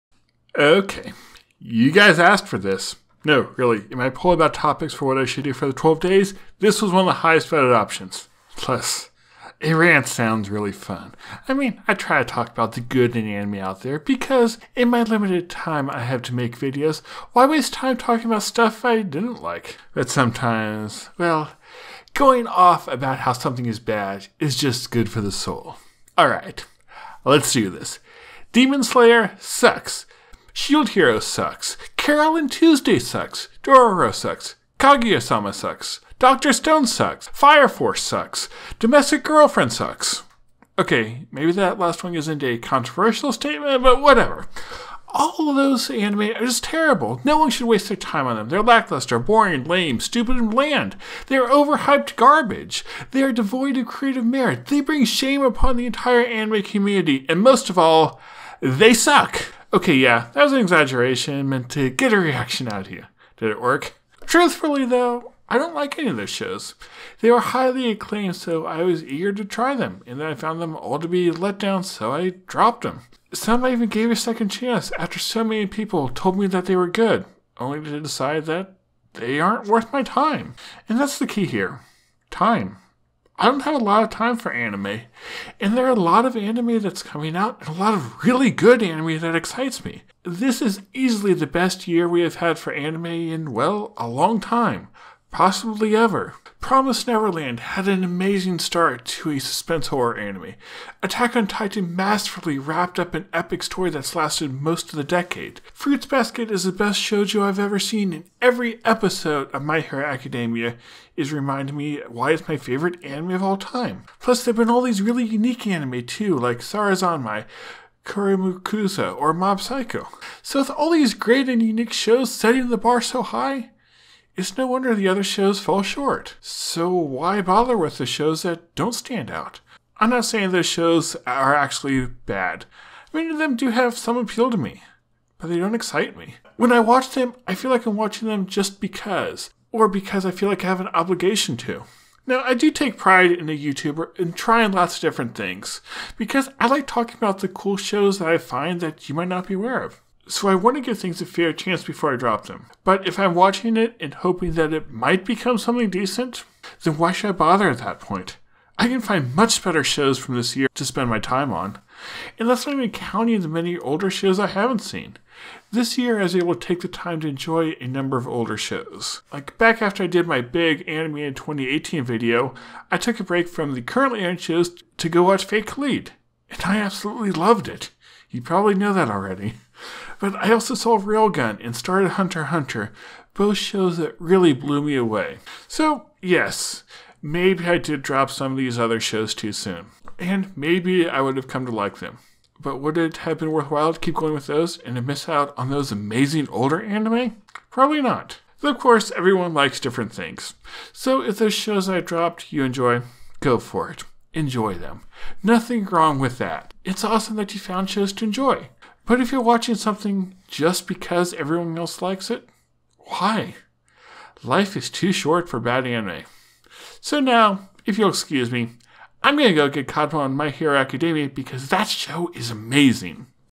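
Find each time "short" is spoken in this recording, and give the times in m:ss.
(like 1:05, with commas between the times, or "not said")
2:05, 3:35.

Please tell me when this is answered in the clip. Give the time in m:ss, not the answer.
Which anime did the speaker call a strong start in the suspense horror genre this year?
1:36.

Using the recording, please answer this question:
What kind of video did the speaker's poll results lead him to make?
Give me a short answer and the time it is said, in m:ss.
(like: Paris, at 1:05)
A rant, at 0:09.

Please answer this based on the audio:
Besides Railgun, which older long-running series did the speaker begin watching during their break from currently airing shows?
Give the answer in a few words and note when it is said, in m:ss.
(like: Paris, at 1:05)
Hunter Hunter, at 3:02.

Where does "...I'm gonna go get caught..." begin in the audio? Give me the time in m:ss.
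3:39.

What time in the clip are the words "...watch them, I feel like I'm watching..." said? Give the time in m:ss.
2:16.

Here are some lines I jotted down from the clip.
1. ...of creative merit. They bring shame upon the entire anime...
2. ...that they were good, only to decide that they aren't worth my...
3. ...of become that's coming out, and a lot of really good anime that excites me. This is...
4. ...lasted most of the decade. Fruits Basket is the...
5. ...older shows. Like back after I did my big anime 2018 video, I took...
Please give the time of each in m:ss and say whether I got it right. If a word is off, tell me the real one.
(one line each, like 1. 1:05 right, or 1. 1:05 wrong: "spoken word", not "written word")
1. 0:53 right
2. 1:16 right
3. 1:26 wrong: "anime", not "become"
4. 1:44 right
5. 2:48 right.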